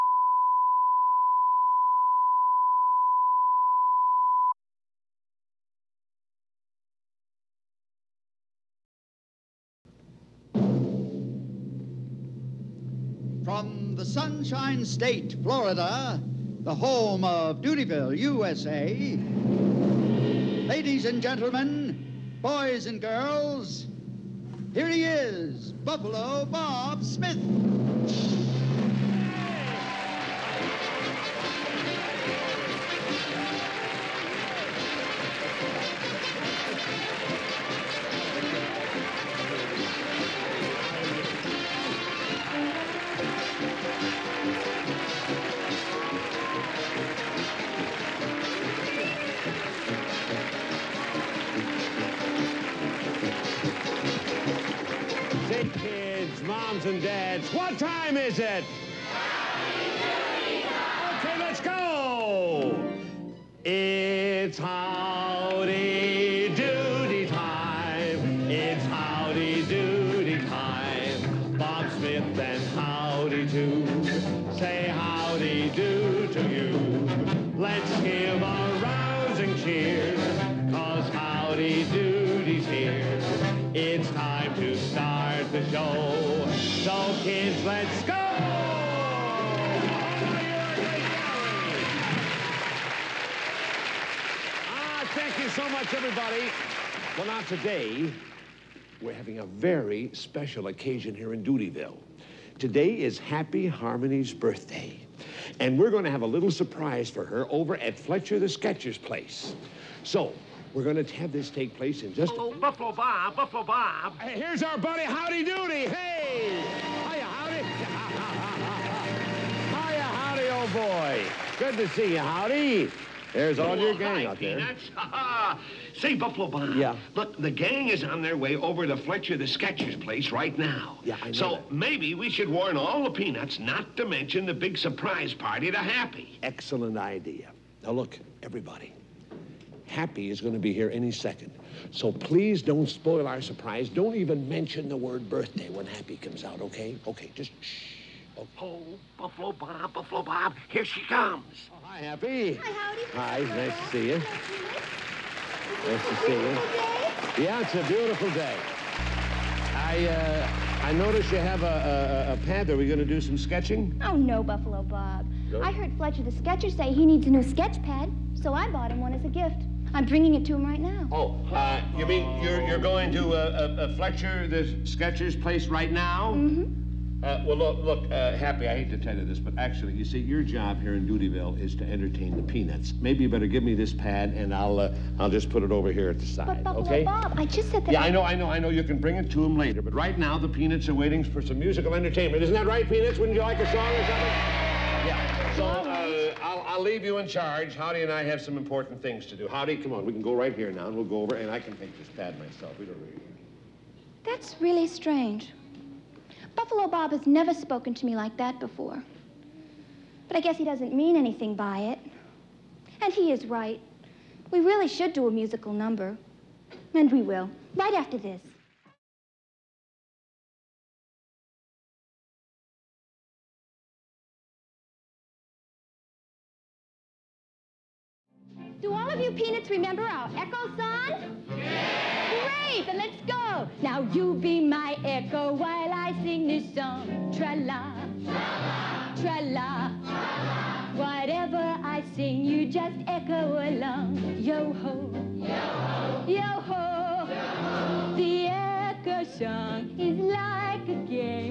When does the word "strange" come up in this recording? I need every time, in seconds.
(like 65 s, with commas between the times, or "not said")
204 s.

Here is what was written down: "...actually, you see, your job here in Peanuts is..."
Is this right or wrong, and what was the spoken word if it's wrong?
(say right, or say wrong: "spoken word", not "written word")
wrong: "Doodyville", not "Peanuts".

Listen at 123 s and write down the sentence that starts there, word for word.
There's all oh, your gang hi, out there.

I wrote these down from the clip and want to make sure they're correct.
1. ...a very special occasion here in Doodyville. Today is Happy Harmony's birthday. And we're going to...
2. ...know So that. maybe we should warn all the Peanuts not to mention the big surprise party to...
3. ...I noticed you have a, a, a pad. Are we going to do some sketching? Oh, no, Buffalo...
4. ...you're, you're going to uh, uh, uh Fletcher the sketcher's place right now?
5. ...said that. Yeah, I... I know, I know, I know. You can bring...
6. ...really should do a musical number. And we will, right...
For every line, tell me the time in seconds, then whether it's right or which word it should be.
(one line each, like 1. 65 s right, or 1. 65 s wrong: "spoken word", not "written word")
1. 99 s right
2. 131 s right
3. 160 s right
4. 172 s right
5. 187 s right
6. 214 s right.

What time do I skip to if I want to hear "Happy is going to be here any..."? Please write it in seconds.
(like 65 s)
139 s.